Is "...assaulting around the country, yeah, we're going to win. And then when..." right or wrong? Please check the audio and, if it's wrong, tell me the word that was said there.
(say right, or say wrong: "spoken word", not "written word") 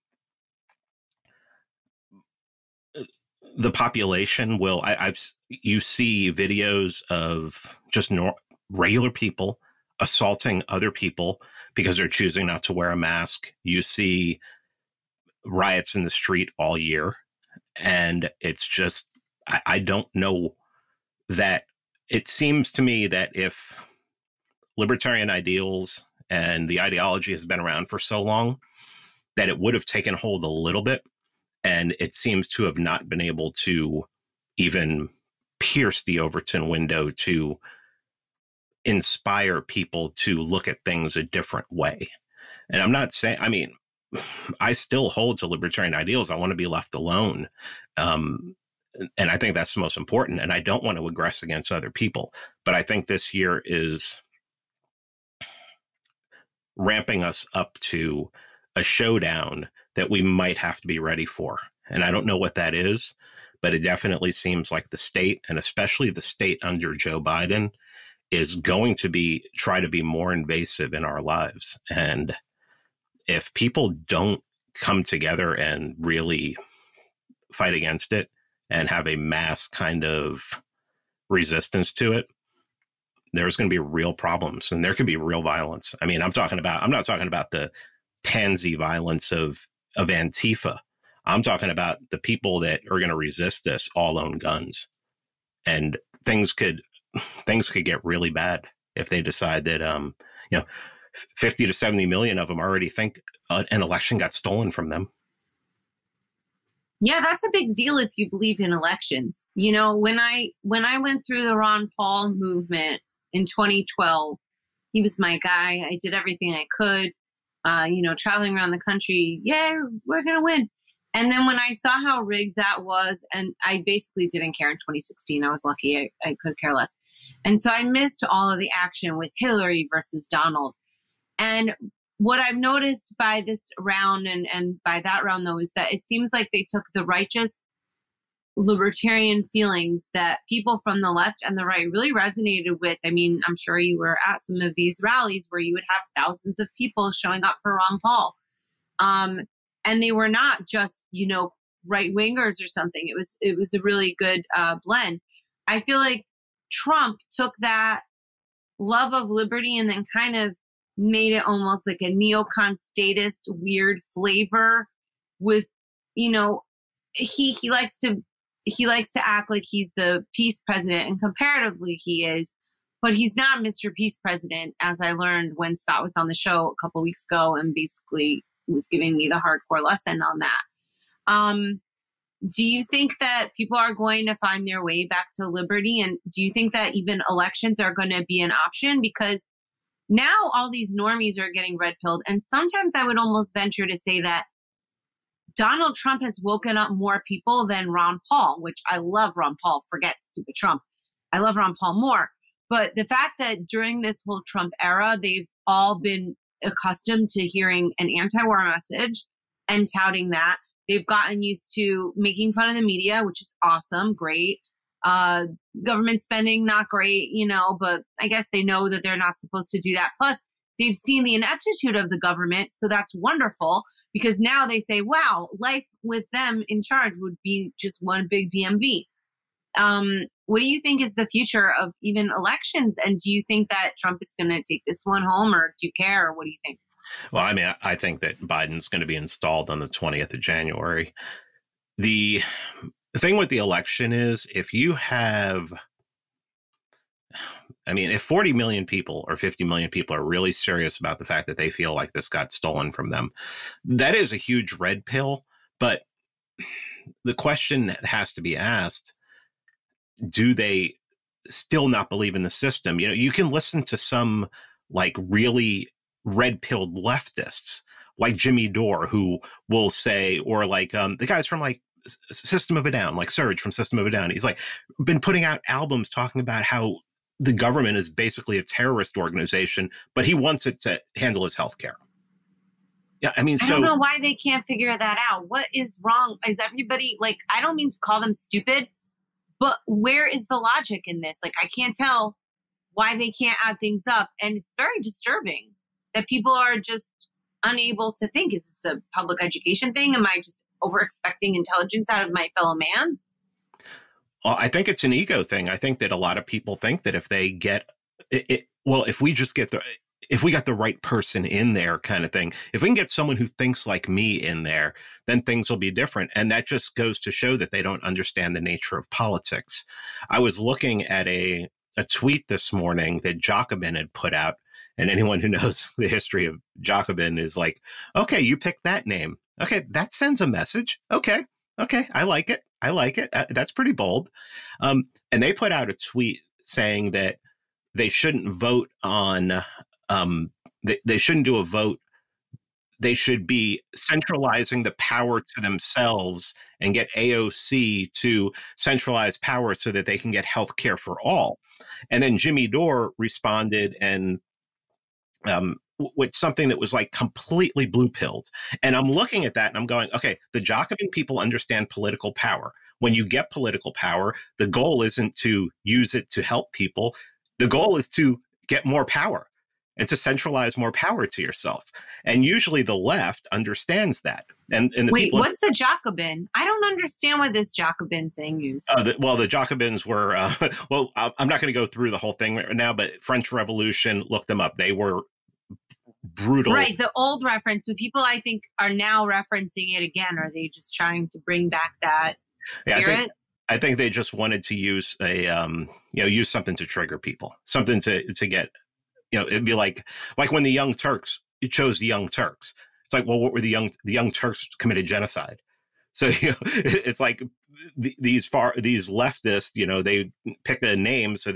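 wrong: "traveling", not "assaulting".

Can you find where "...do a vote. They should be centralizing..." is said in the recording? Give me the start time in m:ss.
5:41.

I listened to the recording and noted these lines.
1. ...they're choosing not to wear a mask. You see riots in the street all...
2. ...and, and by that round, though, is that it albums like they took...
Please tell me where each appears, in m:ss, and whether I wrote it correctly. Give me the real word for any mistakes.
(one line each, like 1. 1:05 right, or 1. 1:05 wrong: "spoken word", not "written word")
1. 0:11 right
2. 2:14 wrong: "seems", not "albums".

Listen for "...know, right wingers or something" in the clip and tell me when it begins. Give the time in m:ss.
2:31.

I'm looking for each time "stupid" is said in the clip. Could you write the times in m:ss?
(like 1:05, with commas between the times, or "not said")
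3:20, 4:48.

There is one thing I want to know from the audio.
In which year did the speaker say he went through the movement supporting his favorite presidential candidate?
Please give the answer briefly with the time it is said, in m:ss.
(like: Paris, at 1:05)
2012, at 1:53.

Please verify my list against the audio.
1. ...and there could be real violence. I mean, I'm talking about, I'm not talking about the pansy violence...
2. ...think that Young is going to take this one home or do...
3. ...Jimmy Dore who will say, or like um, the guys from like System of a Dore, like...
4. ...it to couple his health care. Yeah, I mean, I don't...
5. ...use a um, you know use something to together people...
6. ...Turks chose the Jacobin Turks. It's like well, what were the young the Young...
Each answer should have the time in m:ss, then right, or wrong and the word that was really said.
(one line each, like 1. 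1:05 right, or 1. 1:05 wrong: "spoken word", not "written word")
1. 1:24 right
2. 3:53 wrong: "Trump", not "Young"
3. 4:28 wrong: "Down", not "Dore"
4. 4:40 wrong: "handle", not "couple"
5. 6:34 wrong: "trigger", not "together"
6. 6:40 wrong: "Young", not "Jacobin".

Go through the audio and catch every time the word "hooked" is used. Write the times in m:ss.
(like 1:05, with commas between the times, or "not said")
not said.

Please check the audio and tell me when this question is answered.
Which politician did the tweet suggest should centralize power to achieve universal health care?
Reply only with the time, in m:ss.
5:47.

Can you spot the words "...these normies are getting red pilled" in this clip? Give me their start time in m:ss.
3:10.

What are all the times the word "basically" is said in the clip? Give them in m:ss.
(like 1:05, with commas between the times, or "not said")
2:03, 2:57, 4:38.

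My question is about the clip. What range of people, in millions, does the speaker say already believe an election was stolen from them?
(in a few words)
50 to 70 million.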